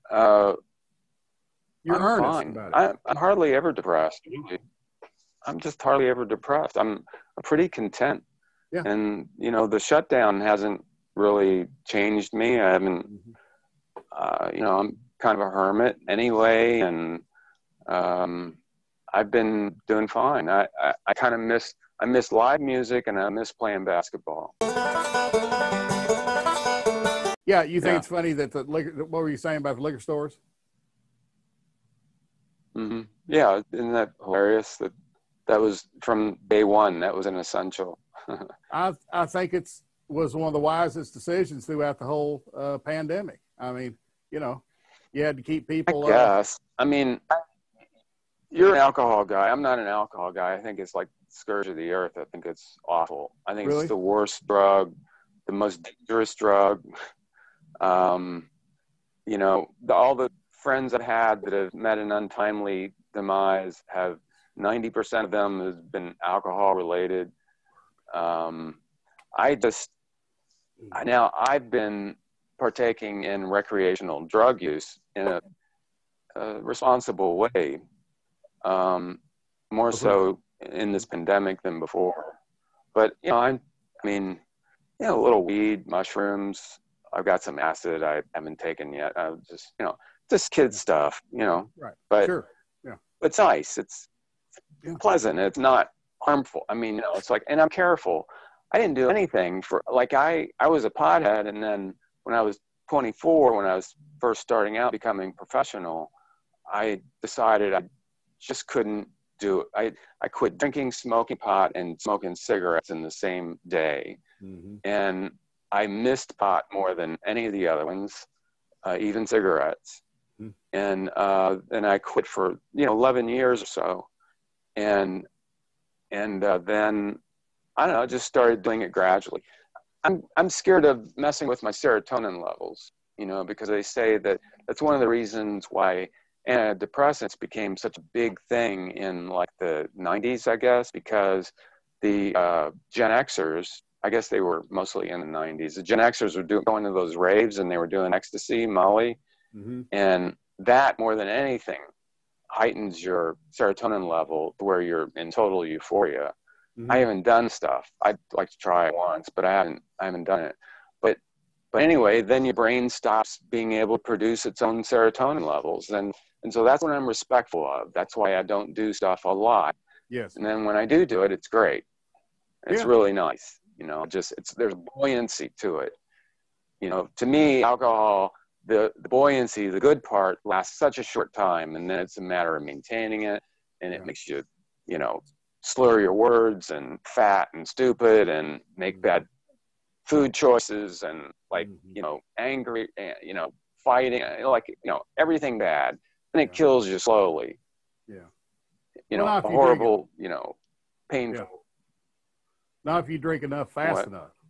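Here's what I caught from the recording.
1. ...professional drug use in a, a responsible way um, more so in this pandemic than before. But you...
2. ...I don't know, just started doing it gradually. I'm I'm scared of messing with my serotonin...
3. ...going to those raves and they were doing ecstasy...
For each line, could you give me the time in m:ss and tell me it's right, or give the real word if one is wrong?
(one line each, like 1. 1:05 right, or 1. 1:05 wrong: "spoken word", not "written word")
1. 1:13 wrong: "recreational", not "professional"
2. 2:07 right
3. 2:26 right.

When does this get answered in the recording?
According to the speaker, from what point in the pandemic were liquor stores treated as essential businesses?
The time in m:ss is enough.
0:36.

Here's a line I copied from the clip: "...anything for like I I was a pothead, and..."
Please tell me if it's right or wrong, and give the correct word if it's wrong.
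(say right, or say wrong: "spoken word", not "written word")
right.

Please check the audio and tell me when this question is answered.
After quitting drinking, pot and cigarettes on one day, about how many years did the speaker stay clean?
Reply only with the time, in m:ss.
2:02.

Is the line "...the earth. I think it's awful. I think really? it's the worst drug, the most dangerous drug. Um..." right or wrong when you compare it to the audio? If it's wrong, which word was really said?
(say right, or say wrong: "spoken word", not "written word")
right.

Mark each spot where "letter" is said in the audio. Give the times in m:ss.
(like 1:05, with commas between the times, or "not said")
not said.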